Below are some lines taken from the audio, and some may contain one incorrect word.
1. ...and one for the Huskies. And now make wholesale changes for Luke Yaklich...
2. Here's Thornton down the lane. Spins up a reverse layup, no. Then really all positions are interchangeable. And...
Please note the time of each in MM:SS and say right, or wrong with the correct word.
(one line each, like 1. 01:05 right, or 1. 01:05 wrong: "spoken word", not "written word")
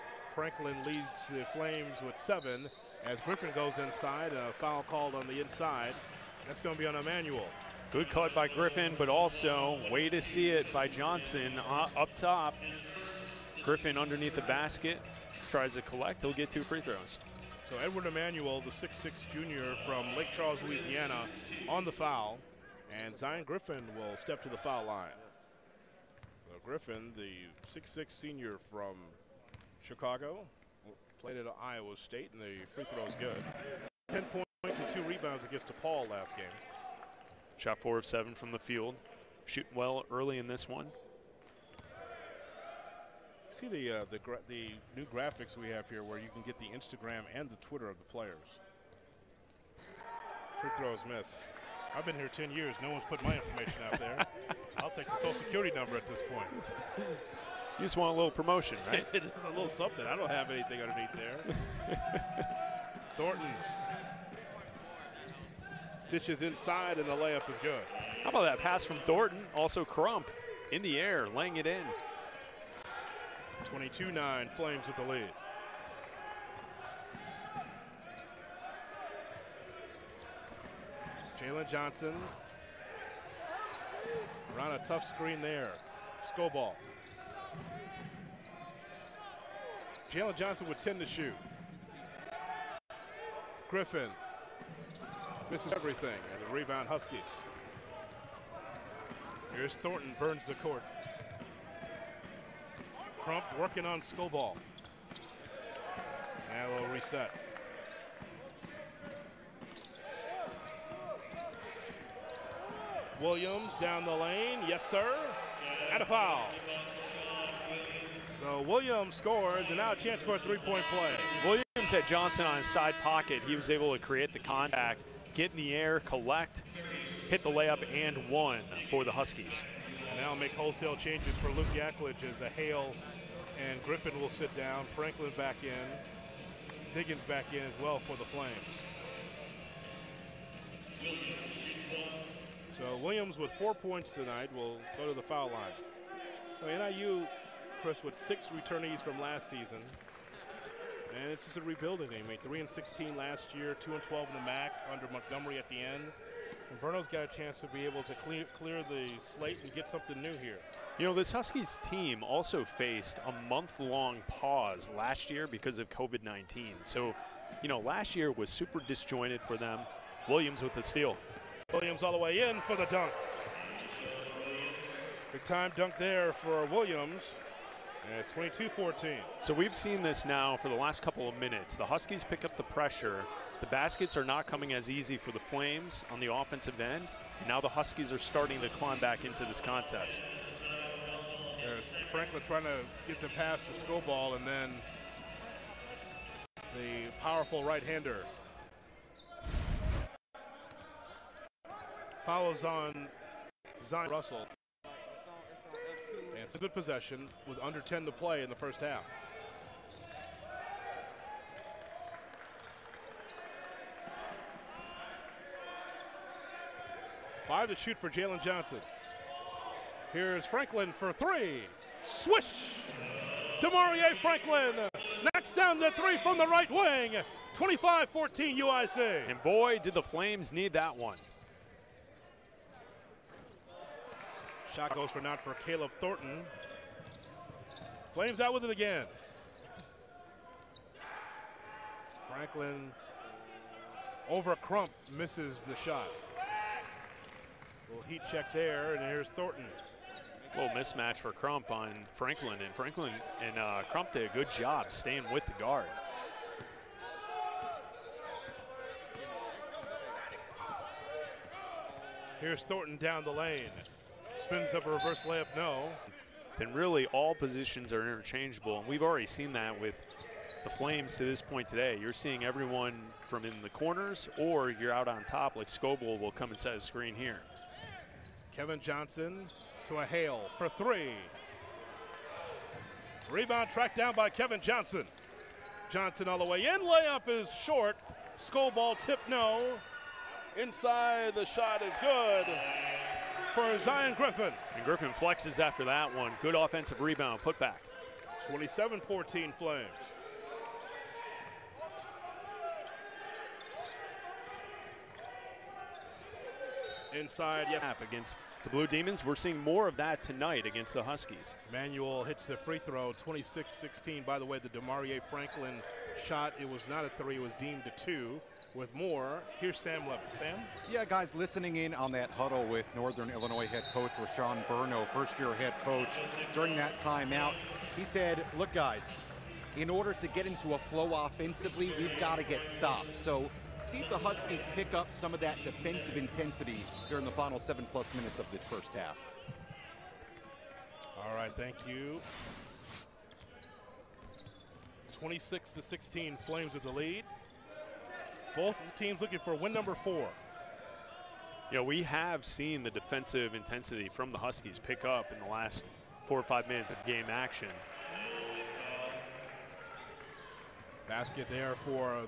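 1. 02:07 right
2. 04:22 right.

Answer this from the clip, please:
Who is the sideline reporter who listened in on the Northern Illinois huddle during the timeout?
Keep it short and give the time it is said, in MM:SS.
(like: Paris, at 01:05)
Sam Levin, at 05:19.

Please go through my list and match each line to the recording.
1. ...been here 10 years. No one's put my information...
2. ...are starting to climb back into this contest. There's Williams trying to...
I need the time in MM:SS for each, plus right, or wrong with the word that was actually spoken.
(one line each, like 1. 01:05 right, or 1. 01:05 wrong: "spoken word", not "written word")
1. 00:52 right
2. 03:08 wrong: "Franklin", not "Williams".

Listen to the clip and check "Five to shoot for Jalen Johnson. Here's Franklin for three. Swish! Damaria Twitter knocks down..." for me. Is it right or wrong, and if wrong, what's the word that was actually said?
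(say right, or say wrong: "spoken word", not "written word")
wrong: "Franklin", not "Twitter".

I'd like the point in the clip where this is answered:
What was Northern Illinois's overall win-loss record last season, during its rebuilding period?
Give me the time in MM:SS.
02:32.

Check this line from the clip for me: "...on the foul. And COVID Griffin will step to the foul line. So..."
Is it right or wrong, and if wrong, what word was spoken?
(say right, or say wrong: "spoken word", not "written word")
wrong: "Zion", not "COVID".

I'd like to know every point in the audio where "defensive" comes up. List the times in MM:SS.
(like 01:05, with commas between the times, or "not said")
05:35, 05:52.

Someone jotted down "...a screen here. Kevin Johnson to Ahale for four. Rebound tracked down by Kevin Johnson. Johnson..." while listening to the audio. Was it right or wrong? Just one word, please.
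wrong.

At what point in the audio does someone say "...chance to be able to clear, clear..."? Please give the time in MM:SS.
02:37.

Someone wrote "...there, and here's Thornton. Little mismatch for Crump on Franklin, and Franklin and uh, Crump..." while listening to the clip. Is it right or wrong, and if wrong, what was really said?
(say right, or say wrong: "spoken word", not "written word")
right.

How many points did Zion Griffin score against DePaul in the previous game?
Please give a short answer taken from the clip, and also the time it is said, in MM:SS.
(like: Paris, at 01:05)
10, at 00:34.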